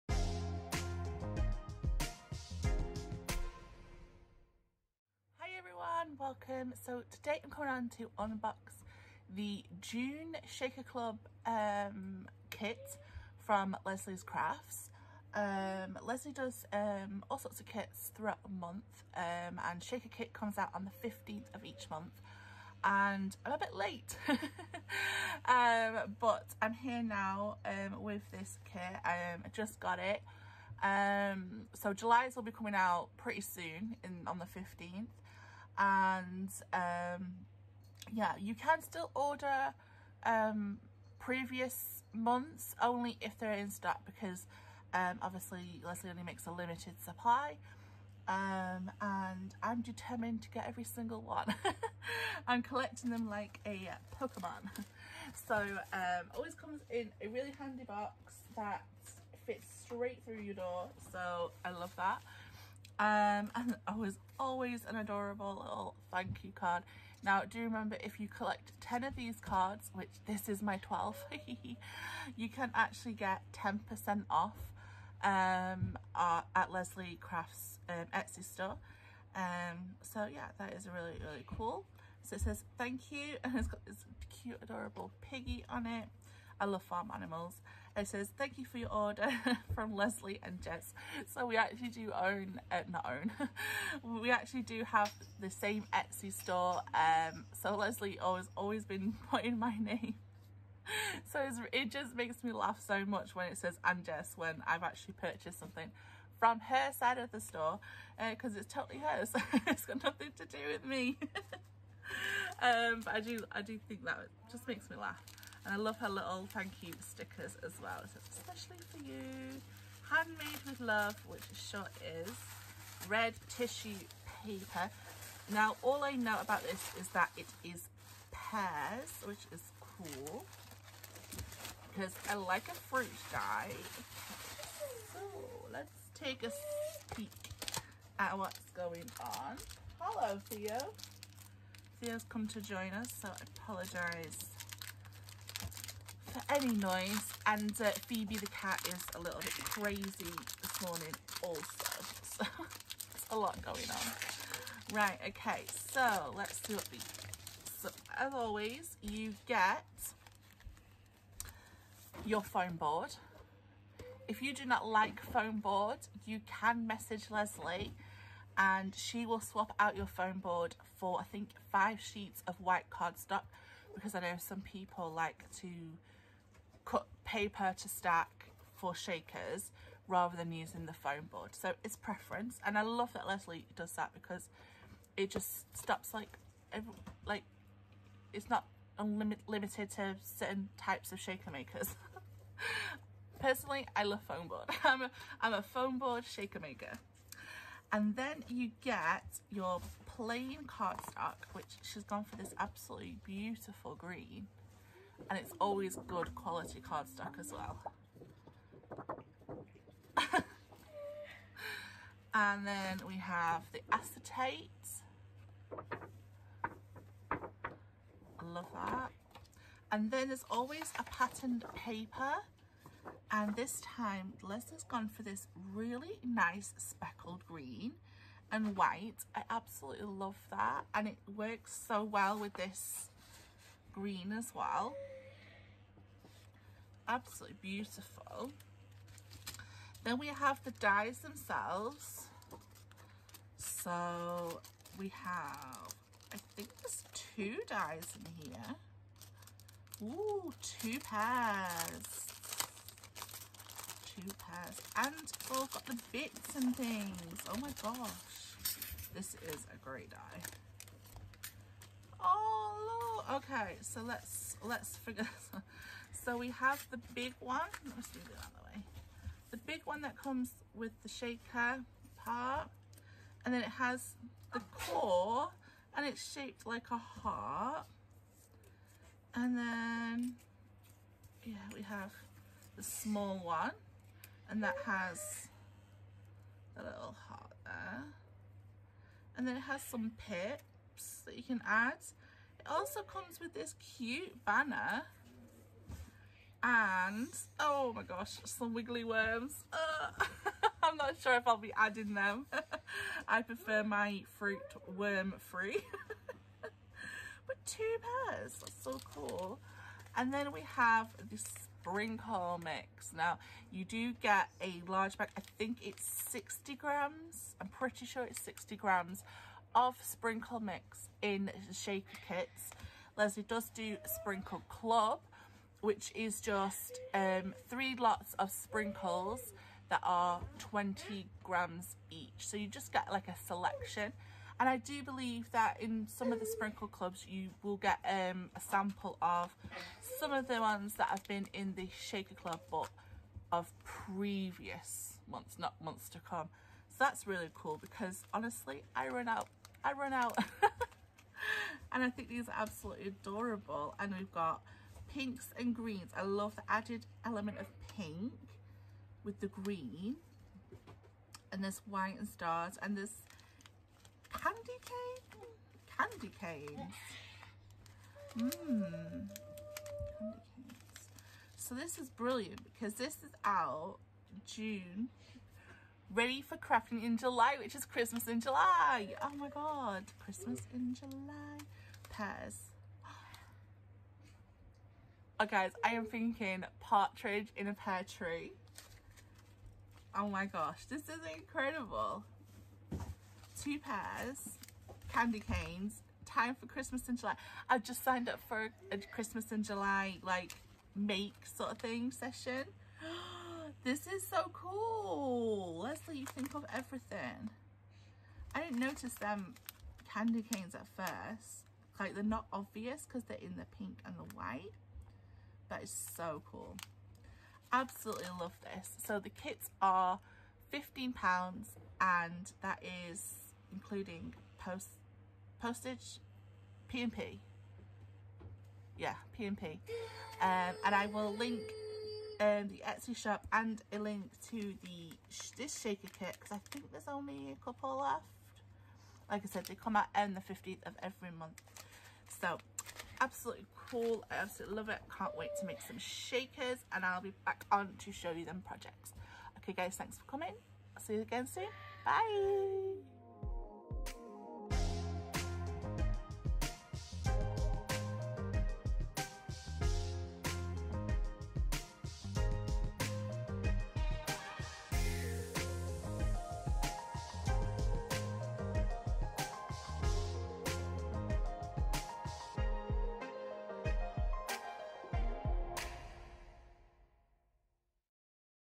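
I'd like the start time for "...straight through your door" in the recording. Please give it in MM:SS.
00:59.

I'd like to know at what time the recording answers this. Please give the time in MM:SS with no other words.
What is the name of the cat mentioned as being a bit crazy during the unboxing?
02:28.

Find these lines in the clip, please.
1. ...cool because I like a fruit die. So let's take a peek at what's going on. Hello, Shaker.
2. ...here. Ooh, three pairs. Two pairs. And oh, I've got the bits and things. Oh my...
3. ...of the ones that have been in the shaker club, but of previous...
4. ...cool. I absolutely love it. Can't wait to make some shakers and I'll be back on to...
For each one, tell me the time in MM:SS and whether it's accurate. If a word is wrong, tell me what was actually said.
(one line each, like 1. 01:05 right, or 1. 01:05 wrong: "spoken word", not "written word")
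1. 02:09 wrong: "Theo", not "Shaker"
2. 04:08 wrong: "two", not "three"
3. 05:40 right
4. 07:23 right.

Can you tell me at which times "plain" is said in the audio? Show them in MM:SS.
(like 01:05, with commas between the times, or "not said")
03:20.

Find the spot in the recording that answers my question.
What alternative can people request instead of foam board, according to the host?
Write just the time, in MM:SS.
02:51.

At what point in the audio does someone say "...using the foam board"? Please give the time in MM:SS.
03:00.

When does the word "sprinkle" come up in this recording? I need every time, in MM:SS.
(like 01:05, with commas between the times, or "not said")
05:11, 05:20, 05:24, 05:28, 05:36.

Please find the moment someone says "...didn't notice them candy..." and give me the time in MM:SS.
06:48.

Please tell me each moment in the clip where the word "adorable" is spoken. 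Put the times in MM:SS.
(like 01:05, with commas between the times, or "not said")
01:04, 01:24, 05:53.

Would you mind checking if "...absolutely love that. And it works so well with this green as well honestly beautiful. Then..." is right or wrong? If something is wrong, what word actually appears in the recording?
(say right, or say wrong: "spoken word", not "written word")
wrong: "absolutely", not "honestly".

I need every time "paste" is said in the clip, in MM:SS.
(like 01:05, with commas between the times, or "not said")
not said.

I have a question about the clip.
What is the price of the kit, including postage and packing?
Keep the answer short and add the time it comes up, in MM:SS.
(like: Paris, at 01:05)
£15, at 07:00.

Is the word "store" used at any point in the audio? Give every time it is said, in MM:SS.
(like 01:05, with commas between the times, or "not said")
01:18, 01:36, 01:47.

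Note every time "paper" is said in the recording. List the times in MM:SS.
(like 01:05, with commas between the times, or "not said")
02:04, 02:57, 03:41.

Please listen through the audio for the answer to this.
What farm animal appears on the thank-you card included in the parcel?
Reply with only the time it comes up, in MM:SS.
01:25.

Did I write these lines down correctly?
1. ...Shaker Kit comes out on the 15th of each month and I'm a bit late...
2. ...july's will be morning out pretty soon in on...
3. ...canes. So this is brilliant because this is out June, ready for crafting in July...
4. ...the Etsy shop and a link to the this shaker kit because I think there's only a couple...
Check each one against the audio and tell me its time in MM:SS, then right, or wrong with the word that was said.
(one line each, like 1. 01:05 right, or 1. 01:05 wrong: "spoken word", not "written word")
1. 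00:19 right
2. 00:31 wrong: "coming", not "morning"
3. 06:10 right
4. 07:12 right.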